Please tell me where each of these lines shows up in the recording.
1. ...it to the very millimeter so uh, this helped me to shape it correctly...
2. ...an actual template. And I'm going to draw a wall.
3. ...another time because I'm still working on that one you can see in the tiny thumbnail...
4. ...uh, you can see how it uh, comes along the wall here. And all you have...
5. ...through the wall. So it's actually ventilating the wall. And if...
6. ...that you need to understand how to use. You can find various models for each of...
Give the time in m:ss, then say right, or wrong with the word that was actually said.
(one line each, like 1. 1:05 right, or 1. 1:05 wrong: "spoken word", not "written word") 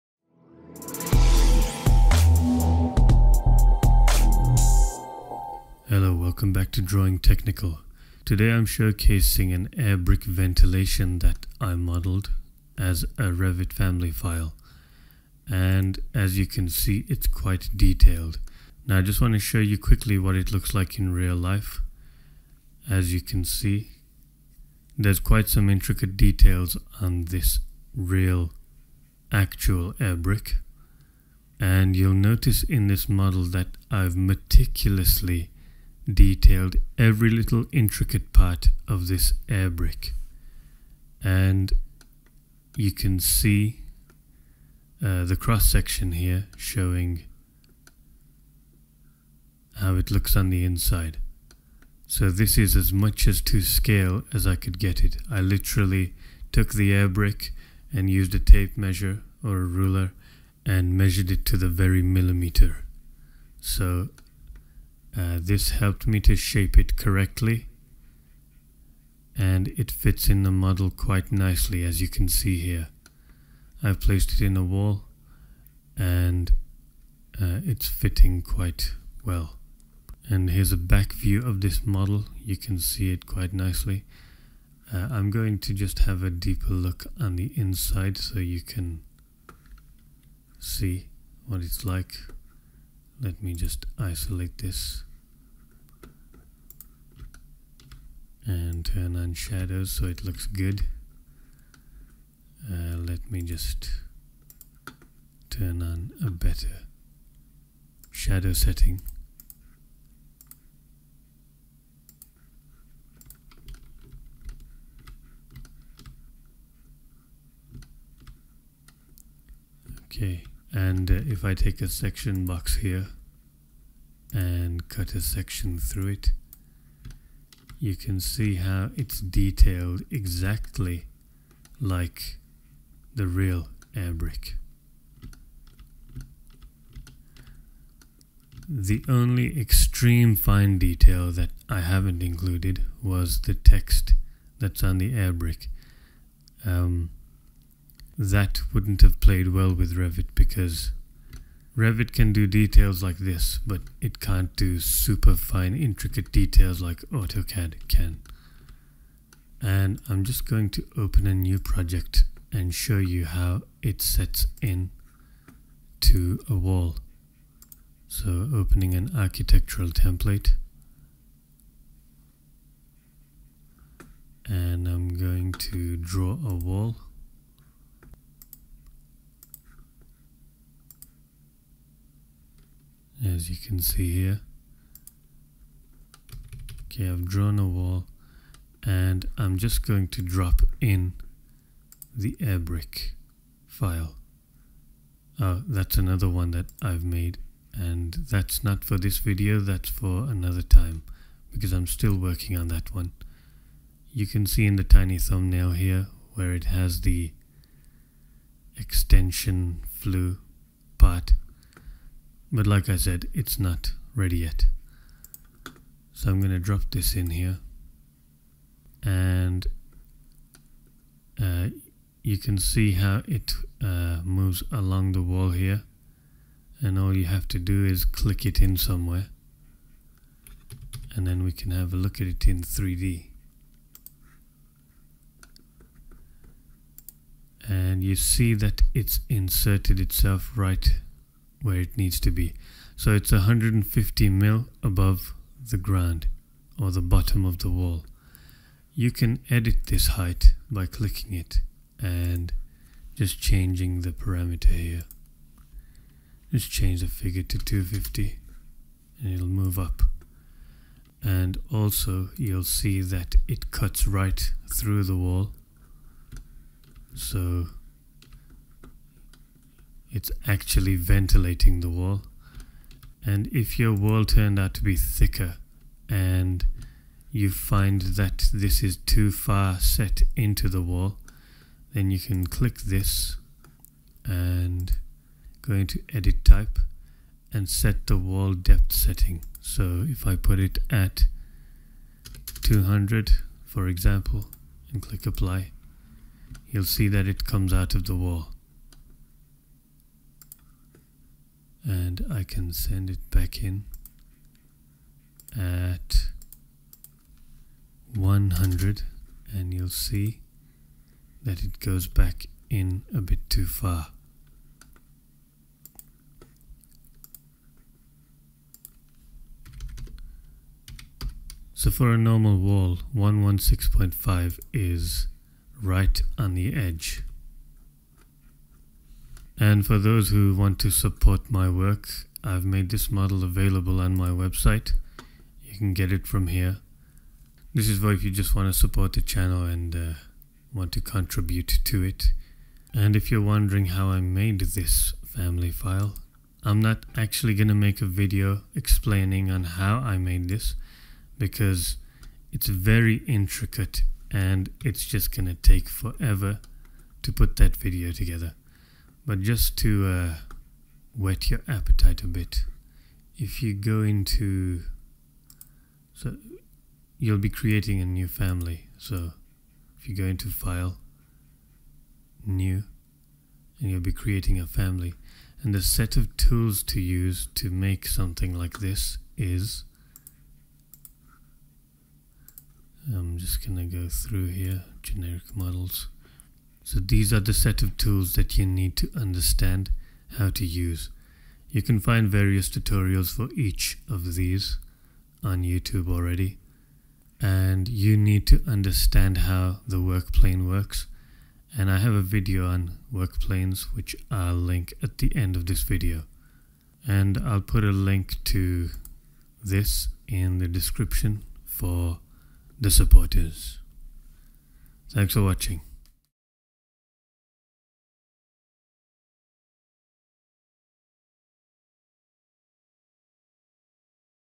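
1. 1:01 right
2. 2:48 wrong: "architectural", not "actual"
3. 3:20 right
4. 3:41 wrong: "moves", not "comes"
5. 4:24 right
6. 6:28 wrong: "tutorials", not "models".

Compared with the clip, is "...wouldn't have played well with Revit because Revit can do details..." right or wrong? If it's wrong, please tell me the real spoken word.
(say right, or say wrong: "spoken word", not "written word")
right.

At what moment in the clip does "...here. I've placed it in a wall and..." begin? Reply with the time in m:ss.
1:12.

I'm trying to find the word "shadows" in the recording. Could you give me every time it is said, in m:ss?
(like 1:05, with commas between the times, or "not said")
1:39, 1:48.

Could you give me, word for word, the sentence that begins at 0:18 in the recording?
Now I just want to show you quickly what it looks like in real life.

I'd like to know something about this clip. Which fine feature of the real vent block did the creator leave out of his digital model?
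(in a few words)
the text.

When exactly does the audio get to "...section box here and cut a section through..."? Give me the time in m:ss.
2:01.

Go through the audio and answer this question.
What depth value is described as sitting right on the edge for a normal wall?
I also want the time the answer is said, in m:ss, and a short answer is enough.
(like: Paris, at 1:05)
116.5, at 5:23.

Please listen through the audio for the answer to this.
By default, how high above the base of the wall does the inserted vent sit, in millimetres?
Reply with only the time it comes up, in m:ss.
4:03.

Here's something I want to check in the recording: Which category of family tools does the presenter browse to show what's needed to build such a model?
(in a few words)
generic models.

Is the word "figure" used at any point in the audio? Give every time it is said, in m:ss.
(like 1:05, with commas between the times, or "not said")
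4:17.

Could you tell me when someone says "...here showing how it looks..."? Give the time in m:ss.
0:46.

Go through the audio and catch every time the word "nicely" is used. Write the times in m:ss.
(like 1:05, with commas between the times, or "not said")
1:11, 1:23.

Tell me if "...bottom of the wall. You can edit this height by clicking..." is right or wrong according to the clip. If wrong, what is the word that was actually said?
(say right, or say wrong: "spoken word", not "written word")
right.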